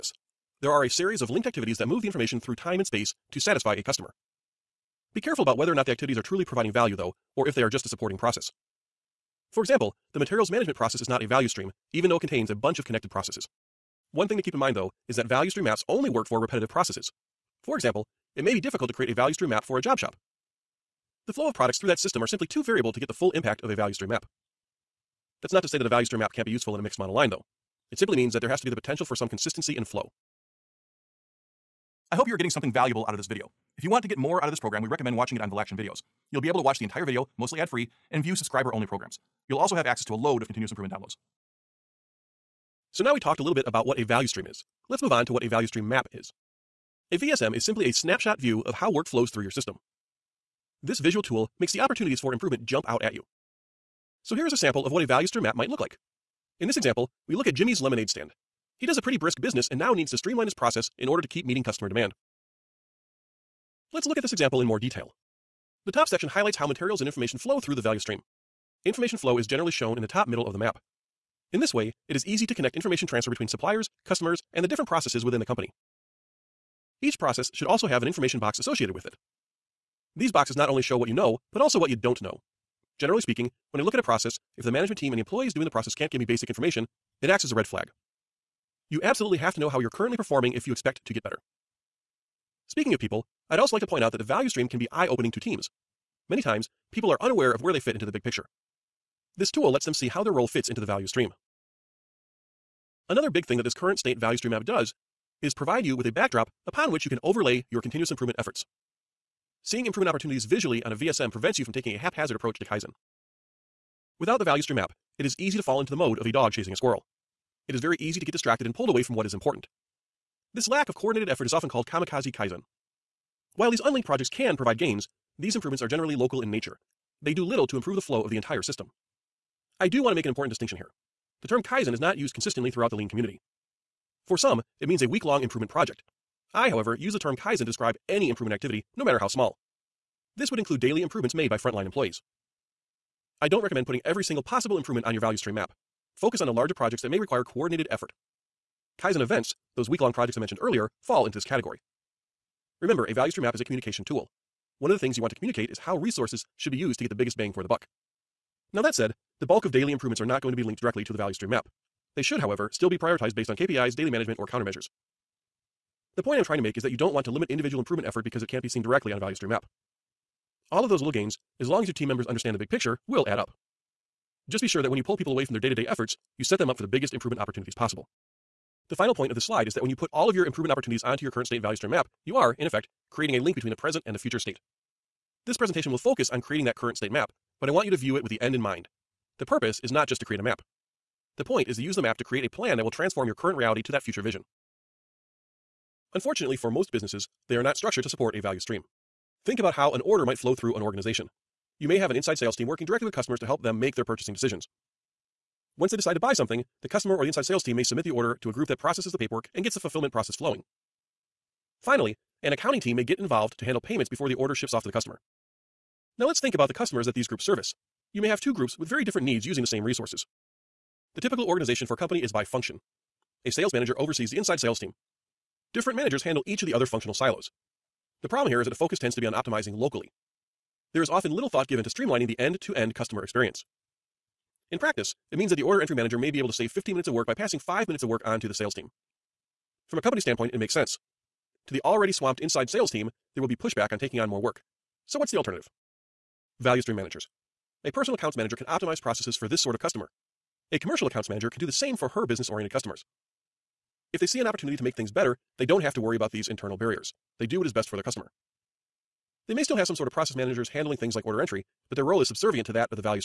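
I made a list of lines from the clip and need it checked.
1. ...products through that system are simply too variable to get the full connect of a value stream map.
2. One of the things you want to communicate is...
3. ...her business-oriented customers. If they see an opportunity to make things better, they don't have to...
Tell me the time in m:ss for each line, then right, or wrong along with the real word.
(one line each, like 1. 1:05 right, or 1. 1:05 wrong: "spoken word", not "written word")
1. 0:21 wrong: "impact", not "connect"
2. 2:34 right
3. 4:12 right.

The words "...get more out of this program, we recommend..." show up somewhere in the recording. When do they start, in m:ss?
0:34.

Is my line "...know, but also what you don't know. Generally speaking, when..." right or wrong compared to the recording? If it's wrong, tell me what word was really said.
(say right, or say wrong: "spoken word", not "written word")
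right.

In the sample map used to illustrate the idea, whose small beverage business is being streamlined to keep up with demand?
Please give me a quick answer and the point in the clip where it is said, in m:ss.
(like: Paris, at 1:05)
Jimmy's lemonade stand, at 0:57.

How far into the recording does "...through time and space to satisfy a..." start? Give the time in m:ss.
0:02.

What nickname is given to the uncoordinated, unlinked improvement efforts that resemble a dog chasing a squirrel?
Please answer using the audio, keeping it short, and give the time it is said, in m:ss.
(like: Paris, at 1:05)
kamikaze Kaizen, at 2:01.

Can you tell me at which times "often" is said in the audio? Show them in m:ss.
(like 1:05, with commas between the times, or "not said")
2:01, 3:51.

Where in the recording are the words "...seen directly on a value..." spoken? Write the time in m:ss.
2:48.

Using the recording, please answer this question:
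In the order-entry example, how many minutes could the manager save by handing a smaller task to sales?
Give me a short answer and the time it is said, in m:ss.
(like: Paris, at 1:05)
15 minutes, at 3:56.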